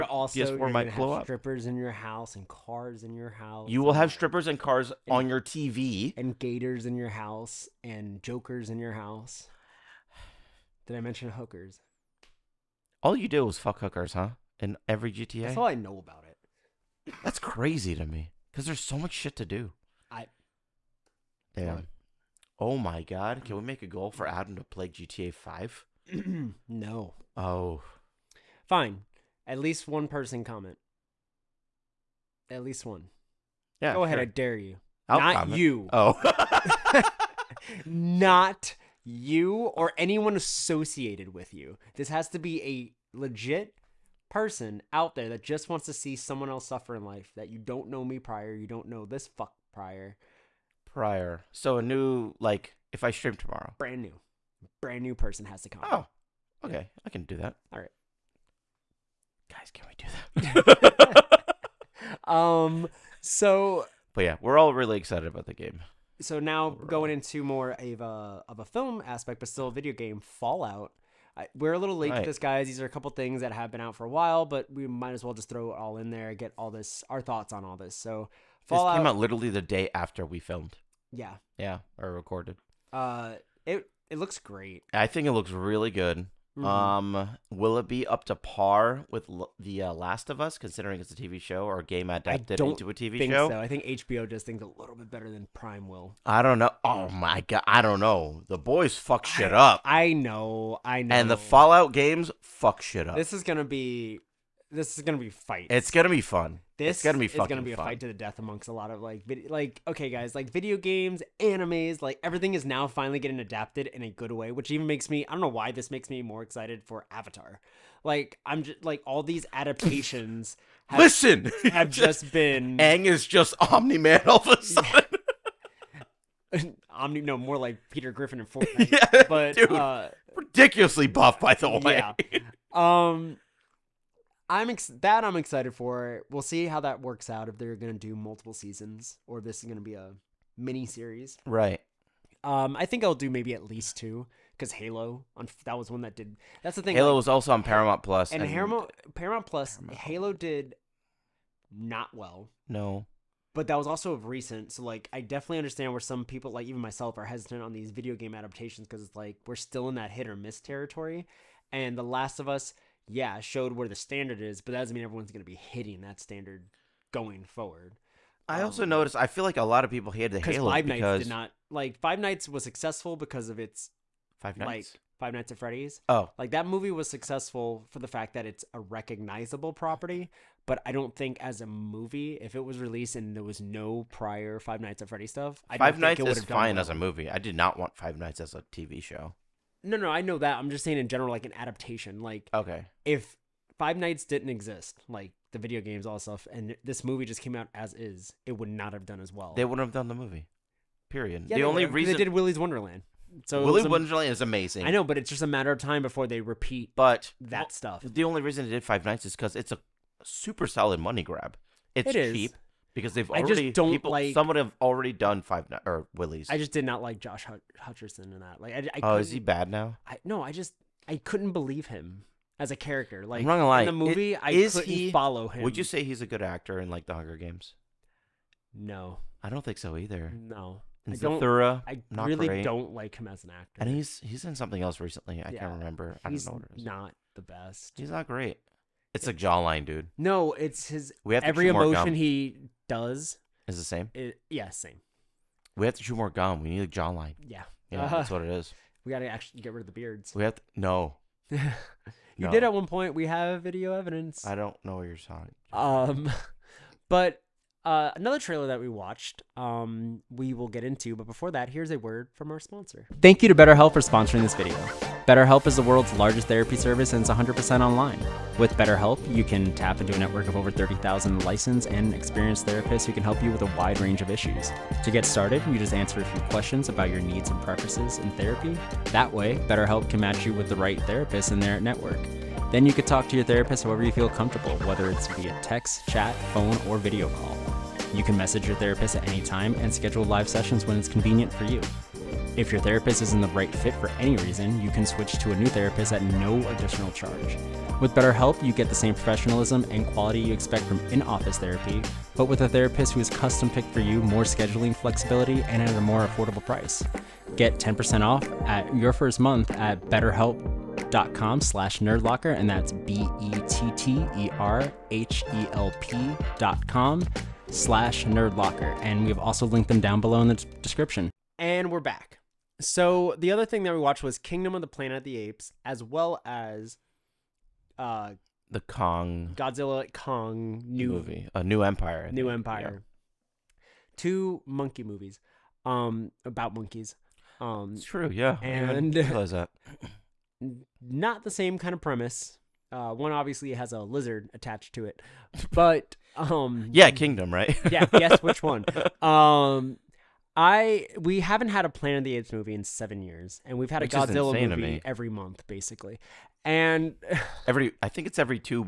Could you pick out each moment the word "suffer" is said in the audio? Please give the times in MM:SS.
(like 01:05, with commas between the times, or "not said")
00:46.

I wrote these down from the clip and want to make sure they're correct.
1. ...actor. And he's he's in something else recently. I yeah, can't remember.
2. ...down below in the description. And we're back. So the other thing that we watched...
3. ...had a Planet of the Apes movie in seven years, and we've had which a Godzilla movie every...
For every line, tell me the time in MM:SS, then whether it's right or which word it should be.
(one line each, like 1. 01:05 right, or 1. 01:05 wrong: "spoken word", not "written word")
1. 03:53 right
2. 05:20 right
3. 05:51 right.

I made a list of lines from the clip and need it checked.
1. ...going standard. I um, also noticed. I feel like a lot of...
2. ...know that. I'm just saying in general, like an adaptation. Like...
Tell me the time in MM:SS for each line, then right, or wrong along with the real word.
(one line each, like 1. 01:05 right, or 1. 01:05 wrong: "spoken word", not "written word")
1. 02:47 wrong: "forward", not "standard"
2. 03:10 right.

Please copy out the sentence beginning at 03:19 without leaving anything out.
They wouldn't have done the movie.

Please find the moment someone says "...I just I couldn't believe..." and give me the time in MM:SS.
03:40.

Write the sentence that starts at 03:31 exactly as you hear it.
It's cheap because they've already I just don't people, like someone have already done Five or Willy's.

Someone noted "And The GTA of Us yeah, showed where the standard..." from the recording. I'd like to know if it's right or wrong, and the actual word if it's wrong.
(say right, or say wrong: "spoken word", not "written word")
wrong: "Last", not "GTA".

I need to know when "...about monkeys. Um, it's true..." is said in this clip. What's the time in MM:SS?
05:36.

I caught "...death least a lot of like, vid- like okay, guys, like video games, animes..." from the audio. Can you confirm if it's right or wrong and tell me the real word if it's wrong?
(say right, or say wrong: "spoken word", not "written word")
wrong: "amongst", not "least".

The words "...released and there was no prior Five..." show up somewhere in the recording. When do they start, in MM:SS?
03:02.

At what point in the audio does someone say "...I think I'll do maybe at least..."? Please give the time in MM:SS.
02:22.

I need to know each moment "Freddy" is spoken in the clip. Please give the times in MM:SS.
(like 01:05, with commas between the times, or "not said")
02:55, 03:05.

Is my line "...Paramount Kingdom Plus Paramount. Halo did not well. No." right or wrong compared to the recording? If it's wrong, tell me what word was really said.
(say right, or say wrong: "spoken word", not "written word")
wrong: "Paramount", not "Kingdom".